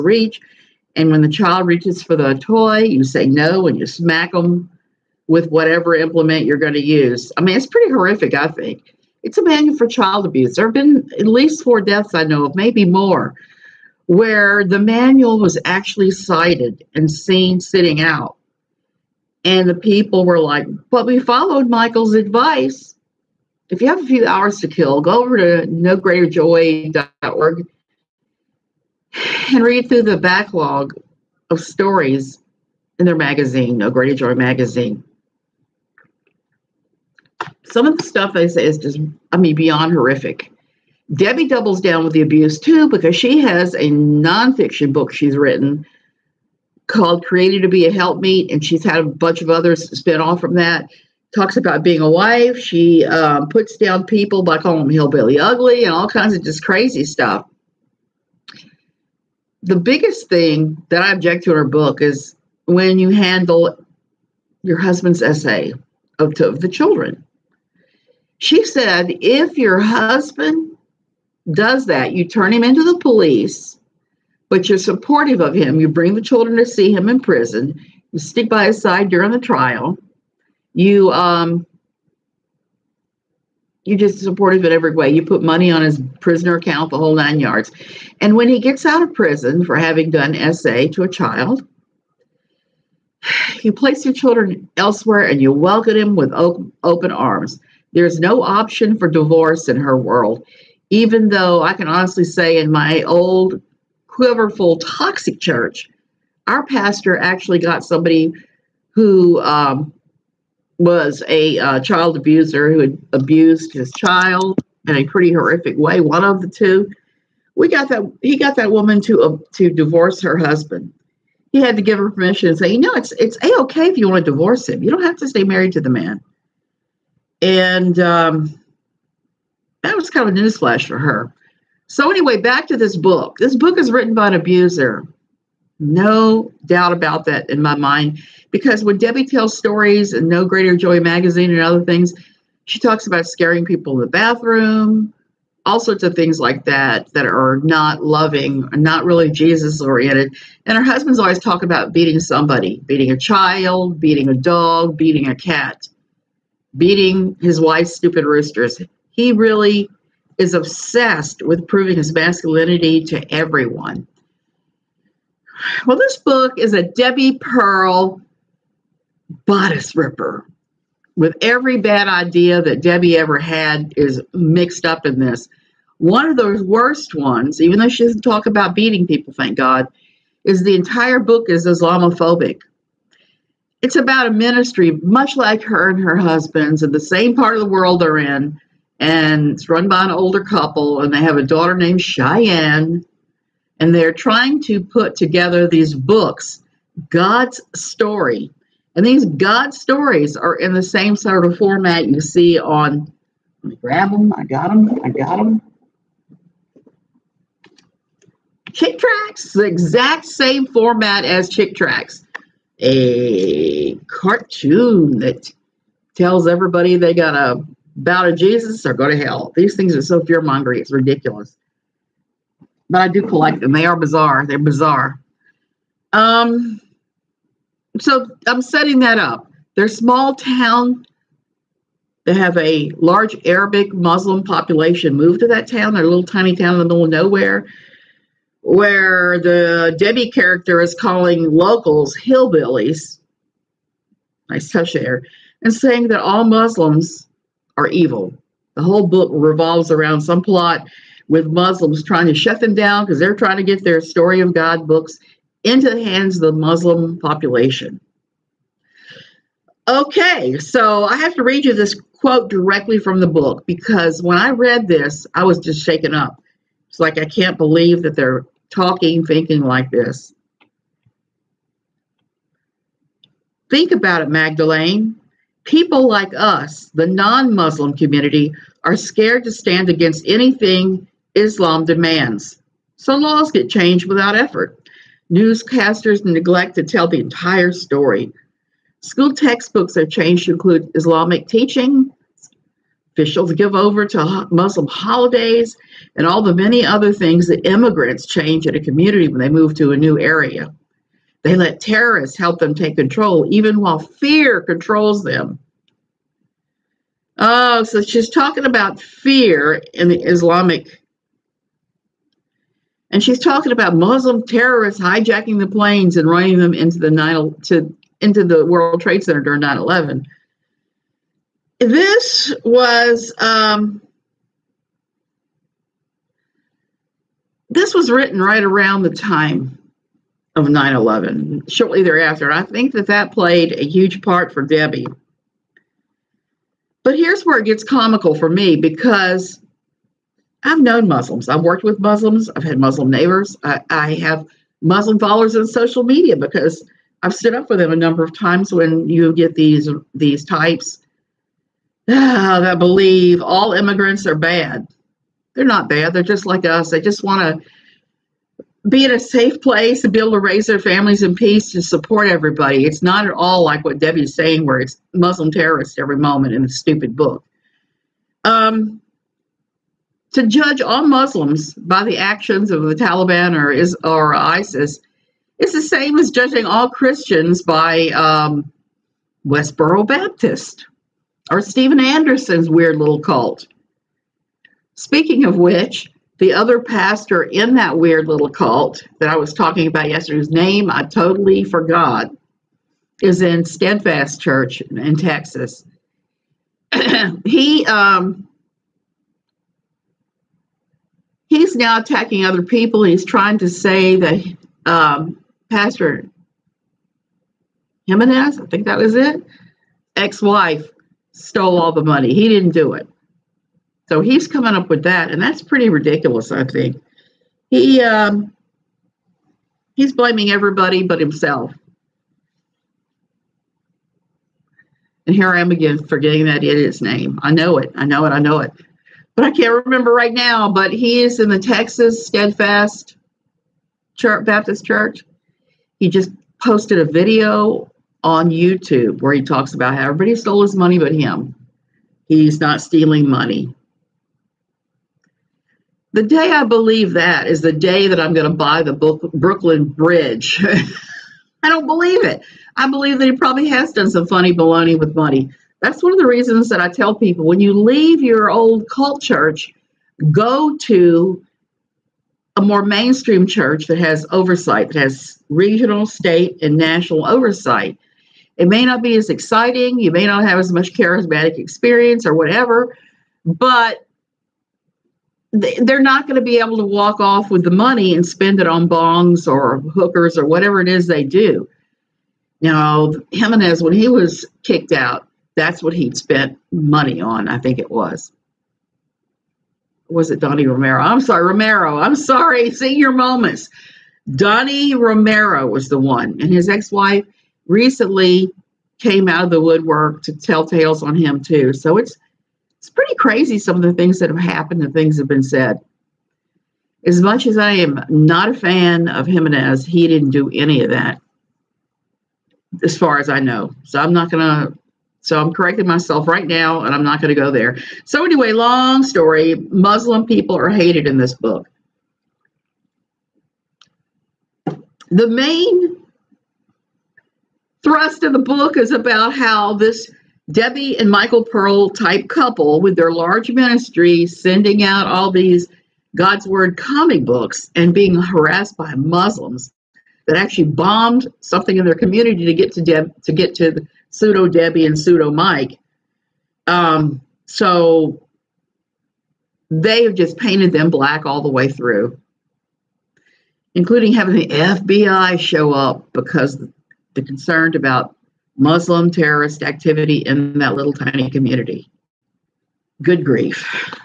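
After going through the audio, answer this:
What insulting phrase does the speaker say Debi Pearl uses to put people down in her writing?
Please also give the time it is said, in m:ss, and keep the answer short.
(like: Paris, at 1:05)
hillbilly ugly, at 0:54.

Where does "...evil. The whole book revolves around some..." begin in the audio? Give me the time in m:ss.
4:07.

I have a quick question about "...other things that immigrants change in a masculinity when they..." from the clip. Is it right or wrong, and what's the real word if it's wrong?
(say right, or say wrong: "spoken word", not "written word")
wrong: "community", not "masculinity".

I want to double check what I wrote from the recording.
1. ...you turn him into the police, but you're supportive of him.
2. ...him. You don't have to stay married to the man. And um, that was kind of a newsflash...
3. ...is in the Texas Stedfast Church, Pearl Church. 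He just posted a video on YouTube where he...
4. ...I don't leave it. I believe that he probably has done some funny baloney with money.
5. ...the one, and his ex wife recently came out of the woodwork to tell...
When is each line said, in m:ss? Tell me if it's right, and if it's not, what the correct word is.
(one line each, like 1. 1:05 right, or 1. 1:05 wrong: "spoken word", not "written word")
1. 1:12 right
2. 2:04 right
3. 7:11 wrong: "Baptist", not "Pearl"
4. 7:31 wrong: "believe", not "leave"
5. 8:15 right.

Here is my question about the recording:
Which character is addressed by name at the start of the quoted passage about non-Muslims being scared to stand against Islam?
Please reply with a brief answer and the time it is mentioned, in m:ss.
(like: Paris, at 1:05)
Magdalene, at 4:34.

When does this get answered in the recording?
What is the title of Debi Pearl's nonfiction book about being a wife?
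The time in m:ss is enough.
0:47.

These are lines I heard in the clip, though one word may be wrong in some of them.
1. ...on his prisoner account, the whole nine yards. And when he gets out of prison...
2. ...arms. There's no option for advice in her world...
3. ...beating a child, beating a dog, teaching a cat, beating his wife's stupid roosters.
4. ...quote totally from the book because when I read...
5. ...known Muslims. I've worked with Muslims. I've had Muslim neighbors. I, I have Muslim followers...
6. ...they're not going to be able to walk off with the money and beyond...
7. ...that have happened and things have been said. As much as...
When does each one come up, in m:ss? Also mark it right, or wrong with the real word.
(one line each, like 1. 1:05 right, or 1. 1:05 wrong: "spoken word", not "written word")
1. 1:25 right
2. 1:37 wrong: "divorce", not "advice"
3. 2:32 wrong: "beating", not "teaching"
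4. 4:22 wrong: "directly", not "totally"
5. 5:40 right
6. 7:55 wrong: "spend", not "beyond"
7. 8:24 right.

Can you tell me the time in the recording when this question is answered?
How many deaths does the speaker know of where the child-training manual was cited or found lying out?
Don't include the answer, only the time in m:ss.
0:11.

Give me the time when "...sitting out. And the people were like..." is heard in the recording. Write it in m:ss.
0:17.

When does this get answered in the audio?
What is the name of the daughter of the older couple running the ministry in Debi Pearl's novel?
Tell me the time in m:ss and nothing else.
3:12.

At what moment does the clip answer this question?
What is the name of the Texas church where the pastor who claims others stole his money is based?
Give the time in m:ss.
6:33.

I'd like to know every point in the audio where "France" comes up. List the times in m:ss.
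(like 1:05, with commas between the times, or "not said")
not said.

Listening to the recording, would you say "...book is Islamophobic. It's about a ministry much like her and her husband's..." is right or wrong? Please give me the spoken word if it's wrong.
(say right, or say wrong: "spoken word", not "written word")
right.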